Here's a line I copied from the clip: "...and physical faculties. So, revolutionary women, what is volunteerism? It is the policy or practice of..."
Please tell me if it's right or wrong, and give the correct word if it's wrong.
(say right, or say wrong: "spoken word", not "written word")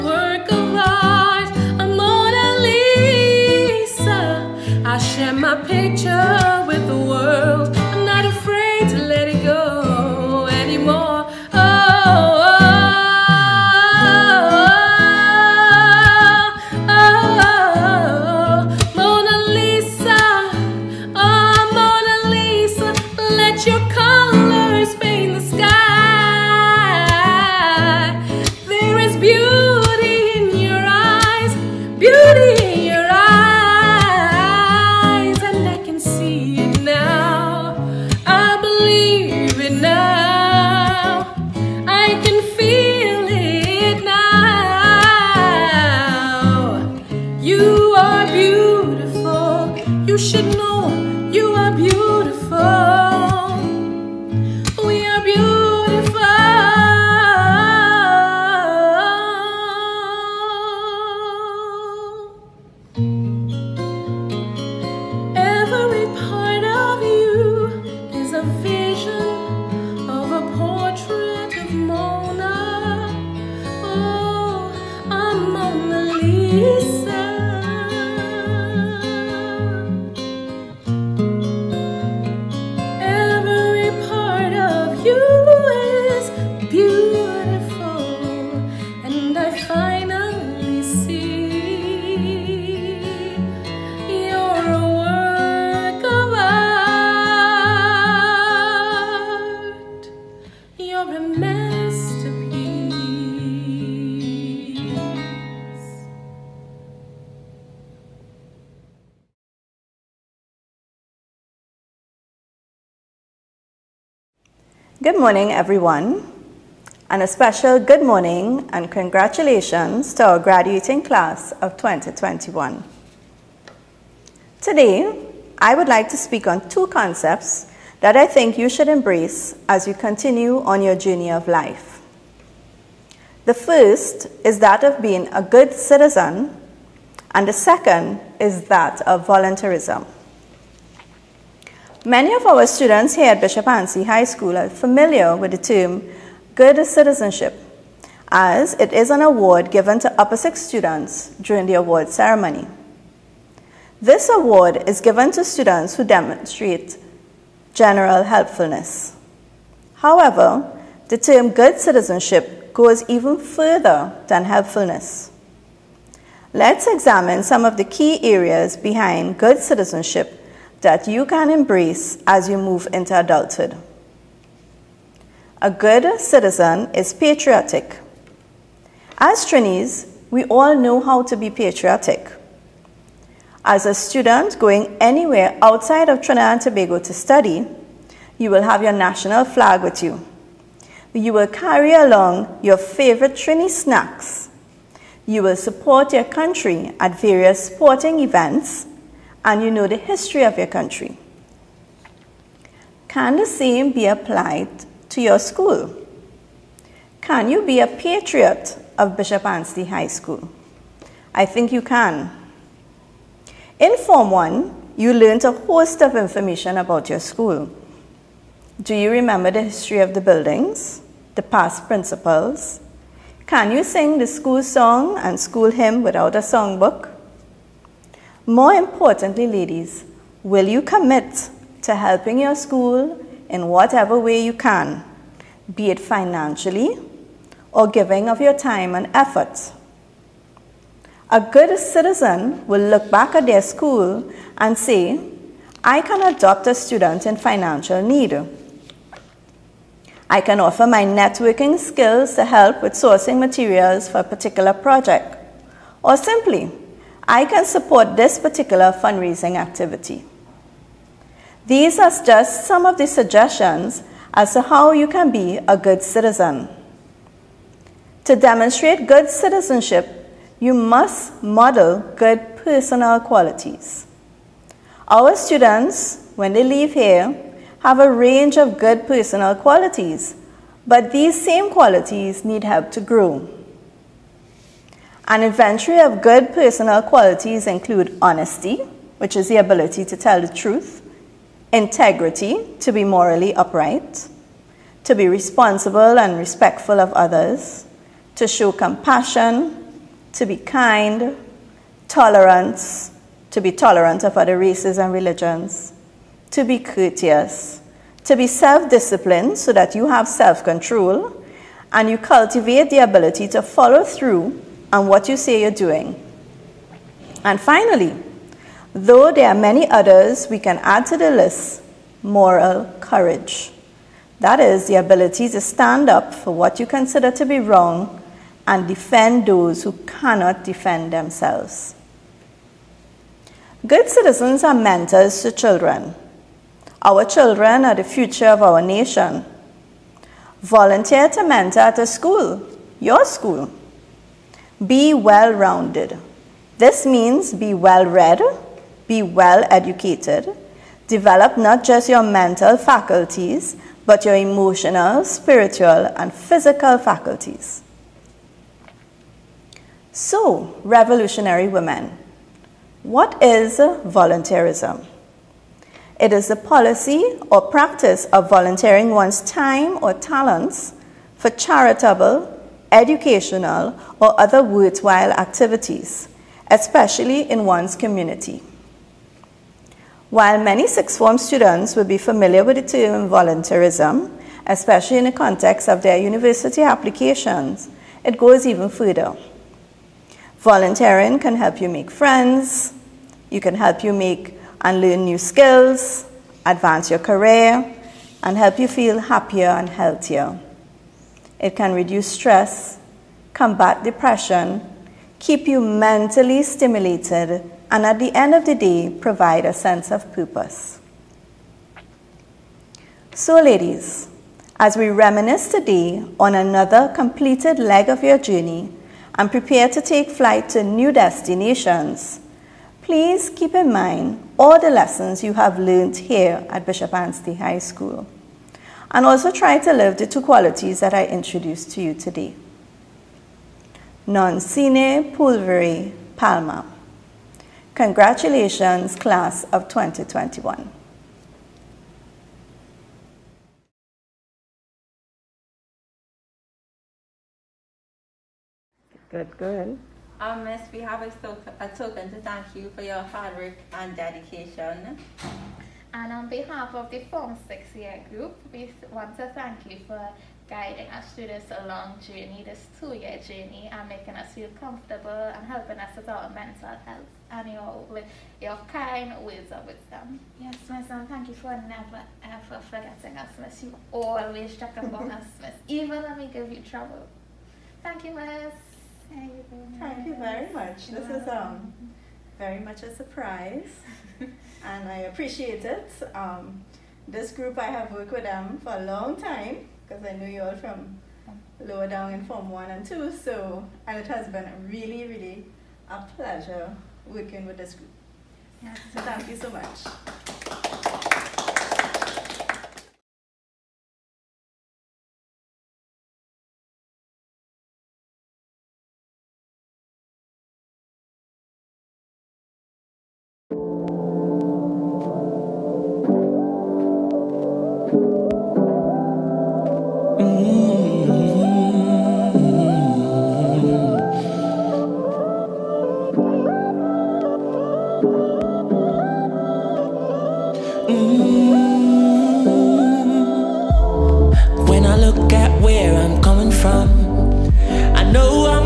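right.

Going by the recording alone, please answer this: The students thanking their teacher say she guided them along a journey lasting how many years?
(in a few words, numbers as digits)
2.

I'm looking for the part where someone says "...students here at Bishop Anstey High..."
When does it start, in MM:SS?
02:22.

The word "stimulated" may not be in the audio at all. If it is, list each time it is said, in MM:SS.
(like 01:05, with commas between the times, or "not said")
06:46.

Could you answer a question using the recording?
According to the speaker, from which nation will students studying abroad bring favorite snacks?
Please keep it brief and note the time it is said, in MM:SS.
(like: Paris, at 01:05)
Trinidad and Tobago, at 03:06.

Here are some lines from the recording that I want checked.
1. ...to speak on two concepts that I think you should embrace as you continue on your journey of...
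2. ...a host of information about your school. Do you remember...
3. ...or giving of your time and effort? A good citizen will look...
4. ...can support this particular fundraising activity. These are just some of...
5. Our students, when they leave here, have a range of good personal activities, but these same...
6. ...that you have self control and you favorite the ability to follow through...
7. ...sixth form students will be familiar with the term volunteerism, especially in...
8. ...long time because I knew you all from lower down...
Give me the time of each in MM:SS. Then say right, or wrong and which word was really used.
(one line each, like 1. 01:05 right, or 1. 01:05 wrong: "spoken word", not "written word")
1. 02:06 right
2. 03:35 right
3. 03:57 right
4. 04:17 right
5. 04:35 wrong: "qualities", not "activities"
6. 05:09 wrong: "cultivate", not "favorite"
7. 06:20 right
8. 08:09 right.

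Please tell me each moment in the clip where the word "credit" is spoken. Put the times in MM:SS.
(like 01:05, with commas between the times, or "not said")
not said.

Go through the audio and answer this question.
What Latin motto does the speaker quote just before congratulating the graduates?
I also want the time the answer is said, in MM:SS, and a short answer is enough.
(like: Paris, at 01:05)
Non sine pulvere palma, at 07:14.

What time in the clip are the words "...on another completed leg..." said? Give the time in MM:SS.
06:56.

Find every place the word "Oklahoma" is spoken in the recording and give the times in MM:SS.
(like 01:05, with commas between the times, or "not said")
not said.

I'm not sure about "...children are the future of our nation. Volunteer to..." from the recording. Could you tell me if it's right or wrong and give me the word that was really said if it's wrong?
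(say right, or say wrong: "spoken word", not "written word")
right.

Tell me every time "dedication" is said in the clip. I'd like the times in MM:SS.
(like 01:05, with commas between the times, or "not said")
07:34.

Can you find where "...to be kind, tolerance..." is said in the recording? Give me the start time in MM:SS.
05:00.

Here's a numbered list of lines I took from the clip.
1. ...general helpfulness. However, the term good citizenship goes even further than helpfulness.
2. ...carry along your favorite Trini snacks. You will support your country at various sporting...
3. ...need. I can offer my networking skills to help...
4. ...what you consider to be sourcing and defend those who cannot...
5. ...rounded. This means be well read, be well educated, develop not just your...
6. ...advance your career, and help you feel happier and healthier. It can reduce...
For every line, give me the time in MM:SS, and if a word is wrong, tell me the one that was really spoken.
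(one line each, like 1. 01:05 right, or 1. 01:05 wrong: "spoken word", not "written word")
1. 02:37 right
2. 03:11 right
3. 04:08 right
4. 05:26 wrong: "wrong", not "sourcing"
5. 05:45 right
6. 06:36 right.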